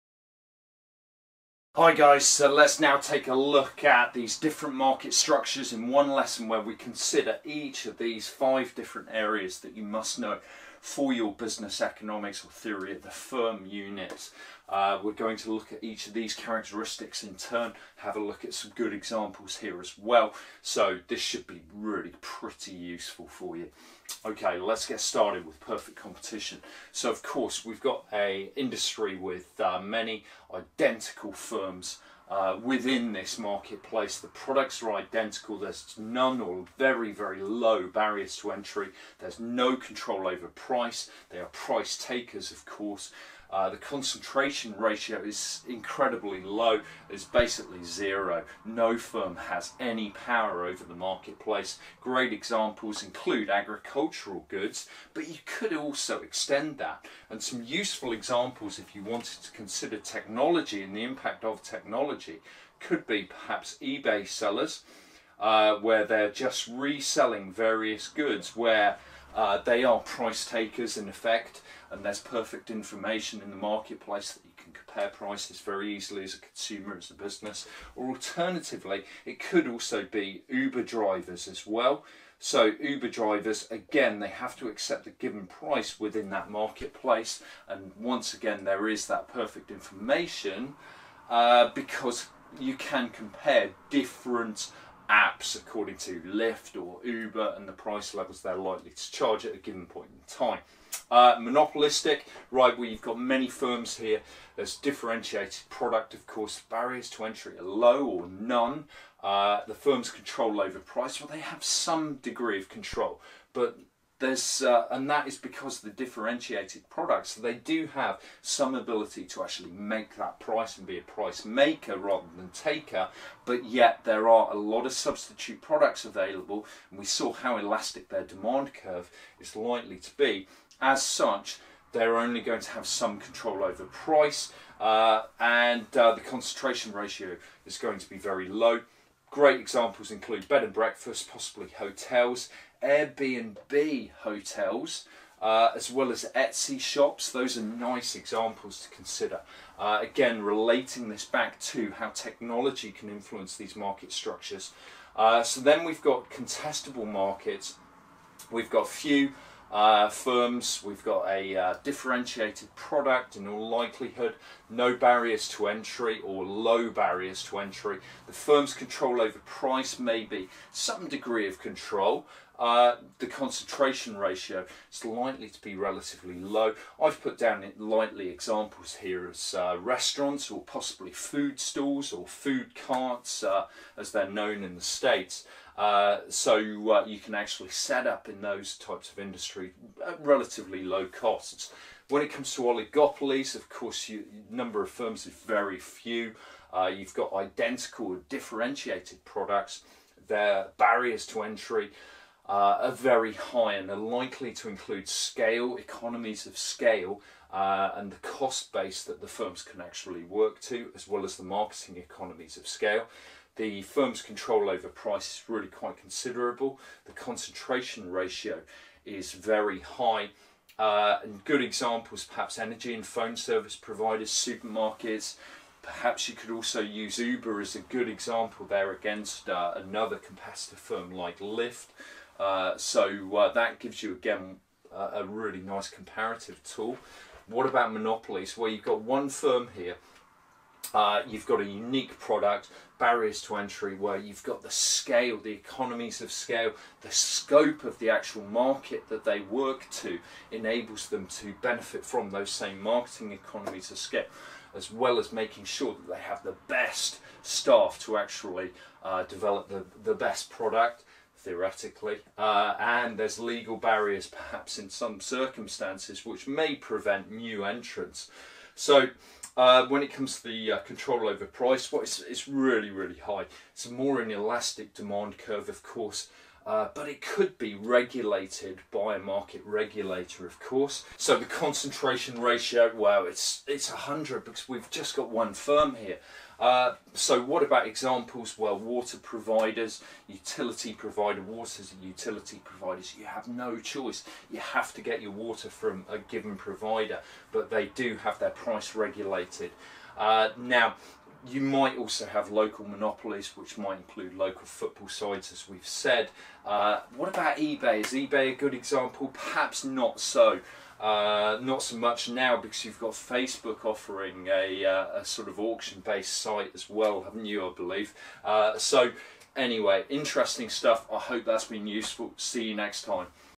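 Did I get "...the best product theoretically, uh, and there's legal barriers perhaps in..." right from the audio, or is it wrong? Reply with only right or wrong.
right.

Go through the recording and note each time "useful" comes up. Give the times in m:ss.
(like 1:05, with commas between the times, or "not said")
0:22, 0:57, 5:21.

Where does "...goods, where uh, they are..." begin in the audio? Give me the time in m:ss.
1:08.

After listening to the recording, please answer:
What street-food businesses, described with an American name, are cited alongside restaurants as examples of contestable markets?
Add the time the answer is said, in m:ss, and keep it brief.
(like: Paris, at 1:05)
food carts, at 3:02.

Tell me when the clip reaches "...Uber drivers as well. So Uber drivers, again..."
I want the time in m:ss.
1:20.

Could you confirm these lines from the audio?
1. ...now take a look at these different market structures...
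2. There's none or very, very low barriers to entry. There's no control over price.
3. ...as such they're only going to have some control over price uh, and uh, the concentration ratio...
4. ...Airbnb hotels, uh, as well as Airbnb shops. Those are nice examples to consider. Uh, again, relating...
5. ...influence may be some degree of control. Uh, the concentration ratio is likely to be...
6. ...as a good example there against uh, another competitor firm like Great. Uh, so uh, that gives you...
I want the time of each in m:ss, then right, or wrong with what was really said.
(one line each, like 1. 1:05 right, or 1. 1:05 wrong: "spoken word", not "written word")
1. 0:02 right
2. 0:35 right
3. 2:10 right
4. 2:22 wrong: "Etsy", not "Airbnb"
5. 2:49 wrong: "price", not "influence"
6. 3:47 wrong: "Lyft", not "Great".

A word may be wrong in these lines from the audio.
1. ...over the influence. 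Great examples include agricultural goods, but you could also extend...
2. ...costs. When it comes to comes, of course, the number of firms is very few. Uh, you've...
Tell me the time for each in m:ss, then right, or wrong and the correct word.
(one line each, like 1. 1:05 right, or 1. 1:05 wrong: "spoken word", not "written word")
1. 0:50 wrong: "marketplace", not "influence"
2. 3:11 wrong: "oligopolies", not "comes".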